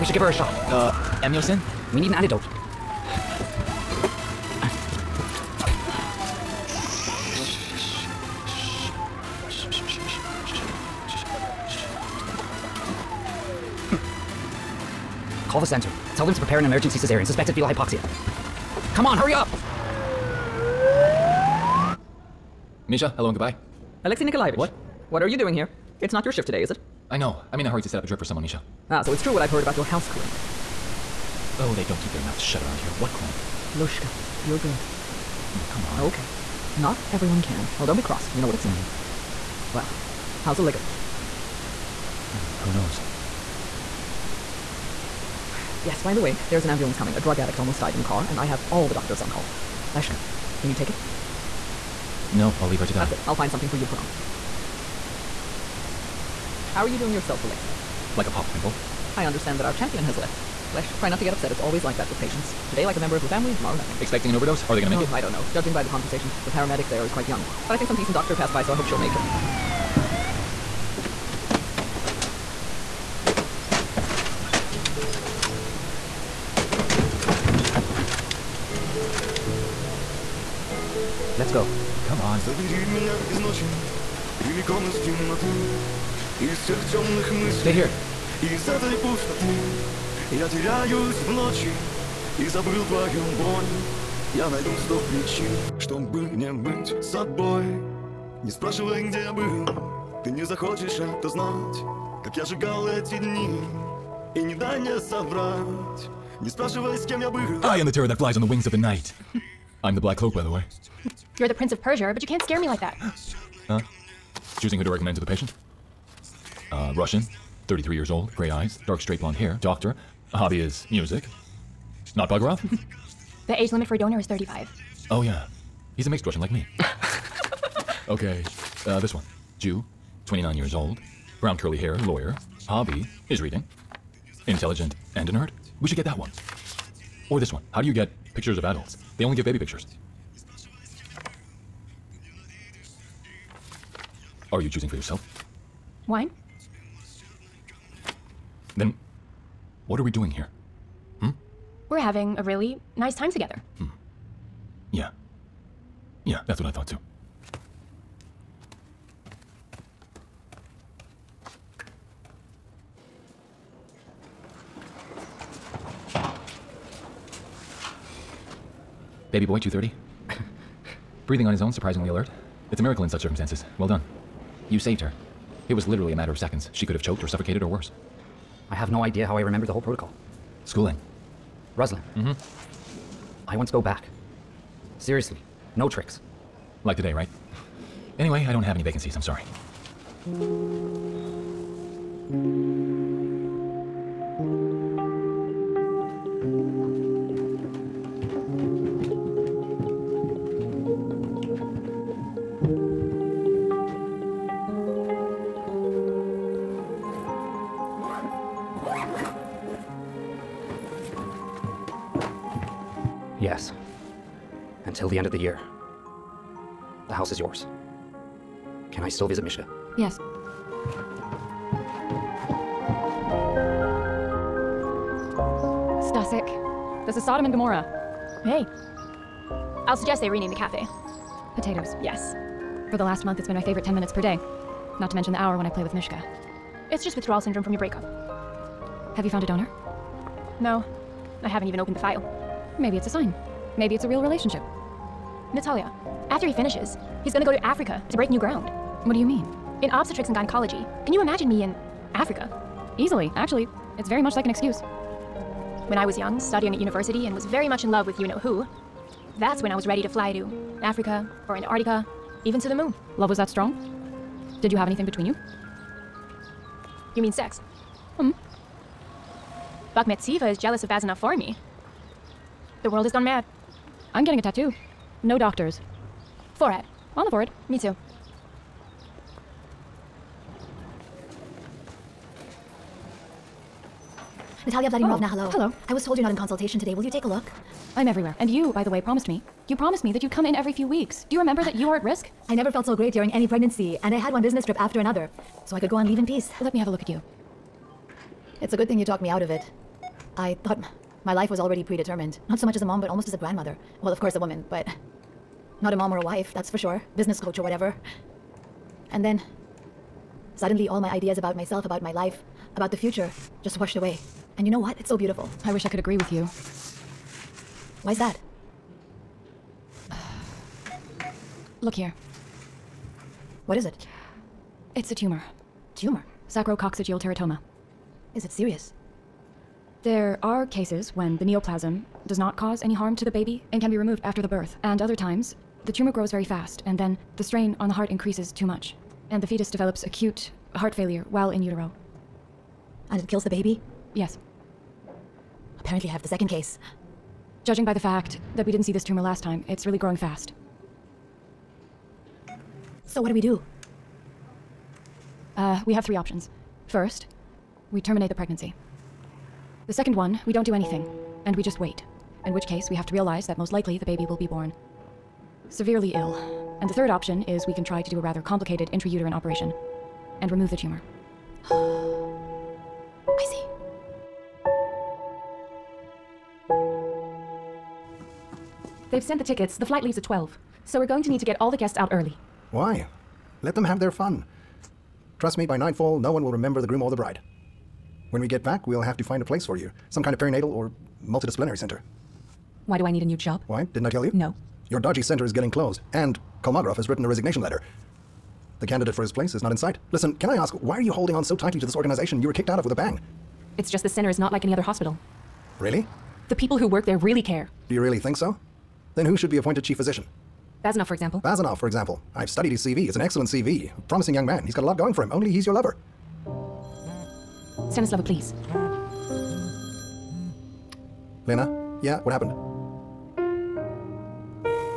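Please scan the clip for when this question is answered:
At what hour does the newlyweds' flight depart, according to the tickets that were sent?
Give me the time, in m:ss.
6:20.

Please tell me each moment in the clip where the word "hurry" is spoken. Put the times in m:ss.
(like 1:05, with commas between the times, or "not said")
0:19, 0:27.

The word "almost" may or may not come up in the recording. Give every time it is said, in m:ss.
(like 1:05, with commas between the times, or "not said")
0:47, 5:03.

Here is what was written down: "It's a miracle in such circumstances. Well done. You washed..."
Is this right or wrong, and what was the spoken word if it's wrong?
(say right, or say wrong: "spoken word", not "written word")
wrong: "saved", not "washed".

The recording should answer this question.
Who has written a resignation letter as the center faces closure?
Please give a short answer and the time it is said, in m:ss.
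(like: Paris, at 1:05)
Kolmogorov, at 6:36.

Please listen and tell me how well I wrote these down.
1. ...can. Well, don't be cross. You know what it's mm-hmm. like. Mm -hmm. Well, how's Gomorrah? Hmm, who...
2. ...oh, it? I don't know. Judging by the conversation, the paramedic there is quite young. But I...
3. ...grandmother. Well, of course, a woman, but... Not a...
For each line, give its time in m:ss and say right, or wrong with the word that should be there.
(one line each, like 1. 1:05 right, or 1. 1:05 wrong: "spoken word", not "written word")
1. 0:37 wrong: "Olegovich", not "Gomorrah"
2. 1:04 right
3. 5:03 right.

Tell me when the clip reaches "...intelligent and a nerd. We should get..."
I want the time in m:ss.
2:14.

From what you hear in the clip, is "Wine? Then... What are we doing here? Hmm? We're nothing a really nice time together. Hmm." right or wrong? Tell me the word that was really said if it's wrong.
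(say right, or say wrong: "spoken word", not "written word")
wrong: "having", not "nothing".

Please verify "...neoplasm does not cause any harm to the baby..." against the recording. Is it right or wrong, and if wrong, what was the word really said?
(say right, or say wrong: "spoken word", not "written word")
right.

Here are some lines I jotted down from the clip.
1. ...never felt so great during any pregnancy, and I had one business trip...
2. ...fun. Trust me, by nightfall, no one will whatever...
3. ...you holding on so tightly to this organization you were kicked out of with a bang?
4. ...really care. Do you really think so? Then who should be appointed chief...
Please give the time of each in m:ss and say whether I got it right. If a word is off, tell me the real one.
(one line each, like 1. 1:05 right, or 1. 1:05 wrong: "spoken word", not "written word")
1. 4:52 right
2. 6:24 wrong: "remember", not "whatever"
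3. 6:41 right
4. 6:47 right.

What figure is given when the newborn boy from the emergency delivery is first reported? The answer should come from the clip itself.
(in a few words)
230.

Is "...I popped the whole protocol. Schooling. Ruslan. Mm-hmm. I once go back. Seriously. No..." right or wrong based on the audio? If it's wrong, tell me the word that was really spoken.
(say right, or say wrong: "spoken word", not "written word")
wrong: "remembered", not "popped".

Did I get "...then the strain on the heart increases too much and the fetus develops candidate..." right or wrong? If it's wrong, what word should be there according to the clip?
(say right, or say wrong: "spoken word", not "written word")
wrong: "acute", not "candidate".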